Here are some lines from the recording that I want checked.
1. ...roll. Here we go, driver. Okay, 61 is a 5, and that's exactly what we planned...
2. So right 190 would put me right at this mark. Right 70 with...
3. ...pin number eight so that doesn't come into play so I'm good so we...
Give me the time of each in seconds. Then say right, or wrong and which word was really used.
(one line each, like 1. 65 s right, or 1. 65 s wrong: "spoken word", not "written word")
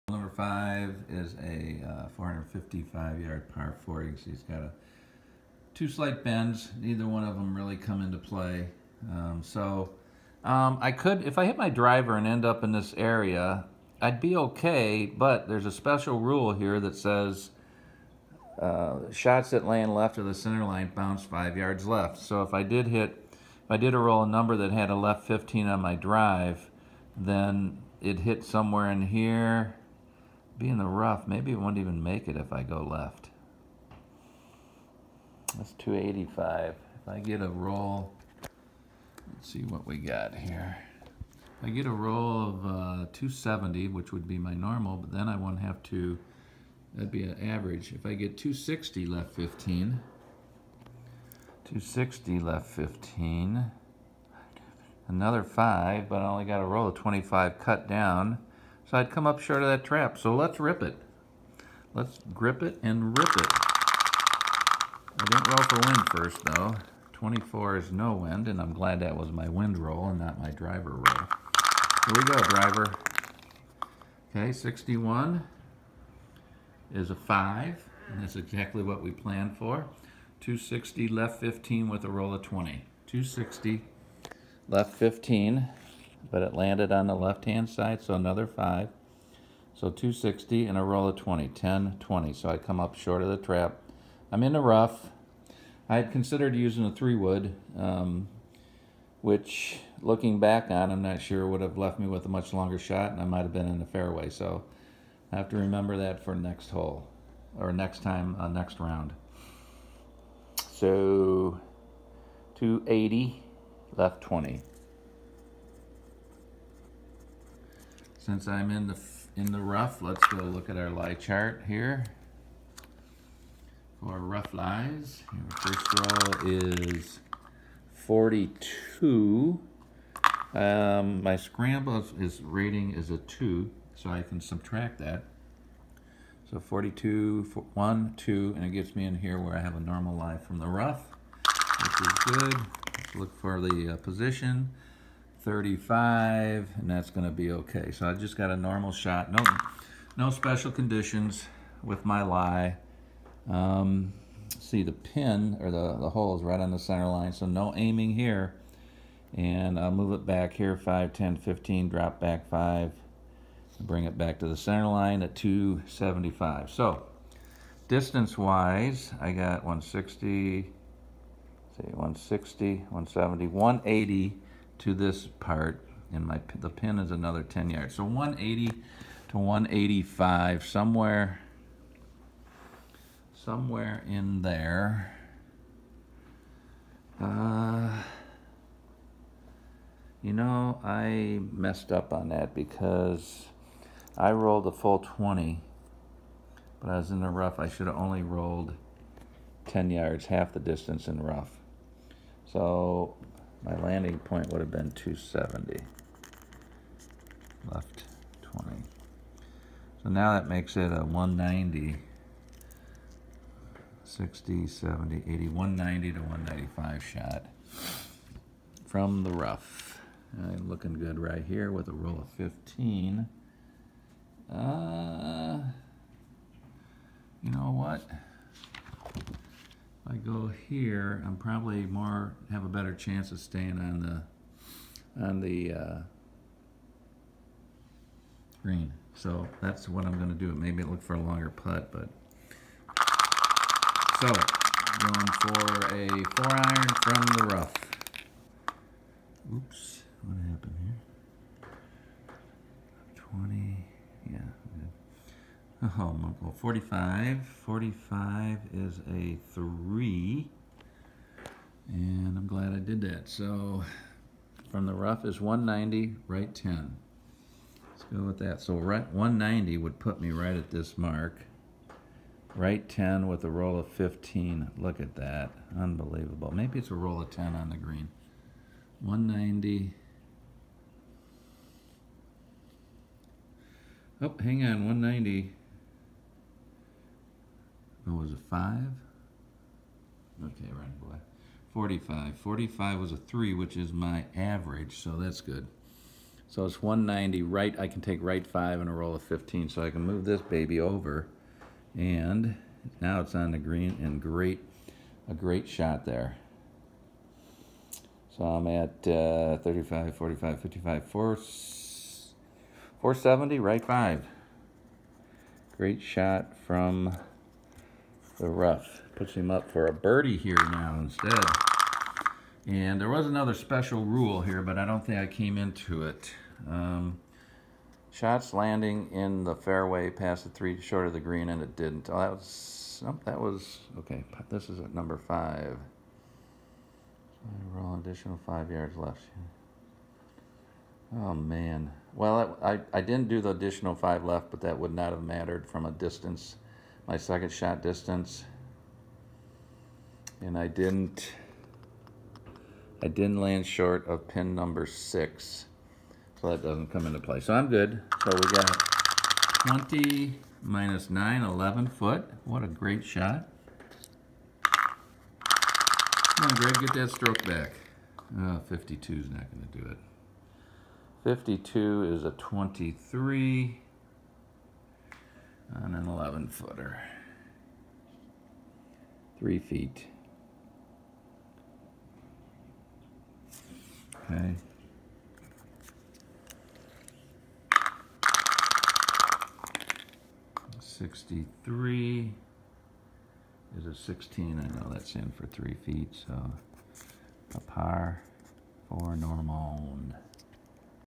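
1. 70 s right
2. 268 s wrong: "10", not "70"
3. 354 s wrong: "six", not "eight".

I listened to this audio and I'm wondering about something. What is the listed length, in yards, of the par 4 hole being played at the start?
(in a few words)
455.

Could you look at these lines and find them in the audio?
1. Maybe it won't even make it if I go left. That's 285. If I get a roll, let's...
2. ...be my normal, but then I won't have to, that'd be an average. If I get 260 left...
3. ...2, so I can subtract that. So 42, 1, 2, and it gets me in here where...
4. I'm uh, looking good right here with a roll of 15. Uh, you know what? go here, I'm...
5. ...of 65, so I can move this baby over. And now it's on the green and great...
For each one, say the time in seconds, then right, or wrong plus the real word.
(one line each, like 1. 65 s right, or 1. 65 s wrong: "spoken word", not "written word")
1. 31 s right
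2. 44 s right
3. 133 s right
4. 220 s right
5. 299 s wrong: "15", not "65".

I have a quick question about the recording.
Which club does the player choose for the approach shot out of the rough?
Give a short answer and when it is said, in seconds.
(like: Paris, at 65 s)
four iron, at 246 s.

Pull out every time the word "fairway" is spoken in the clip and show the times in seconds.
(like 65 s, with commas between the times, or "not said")
103 s, 329 s.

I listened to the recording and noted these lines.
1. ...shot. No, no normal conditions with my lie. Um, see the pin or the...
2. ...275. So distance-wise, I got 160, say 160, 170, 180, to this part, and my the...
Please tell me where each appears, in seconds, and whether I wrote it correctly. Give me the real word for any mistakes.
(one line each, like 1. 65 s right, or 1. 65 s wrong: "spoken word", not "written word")
1. 148 s wrong: "special", not "normal"
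2. 165 s right.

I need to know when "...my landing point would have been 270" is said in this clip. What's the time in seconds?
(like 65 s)
203 s.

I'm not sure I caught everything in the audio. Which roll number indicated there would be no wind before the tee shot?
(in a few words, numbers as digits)
24.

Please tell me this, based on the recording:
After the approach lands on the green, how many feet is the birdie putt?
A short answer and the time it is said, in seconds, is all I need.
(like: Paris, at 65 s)
11, at 361 s.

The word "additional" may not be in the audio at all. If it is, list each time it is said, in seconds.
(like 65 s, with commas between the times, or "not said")
337 s, 343 s.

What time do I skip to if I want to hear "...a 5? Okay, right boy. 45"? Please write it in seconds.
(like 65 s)
288 s.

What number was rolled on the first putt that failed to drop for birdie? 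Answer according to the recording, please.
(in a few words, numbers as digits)
52.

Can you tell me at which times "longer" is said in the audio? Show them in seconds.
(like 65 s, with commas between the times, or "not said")
102 s, 241 s.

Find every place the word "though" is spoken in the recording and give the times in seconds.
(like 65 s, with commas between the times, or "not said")
66 s.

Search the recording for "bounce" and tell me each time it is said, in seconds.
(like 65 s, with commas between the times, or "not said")
20 s.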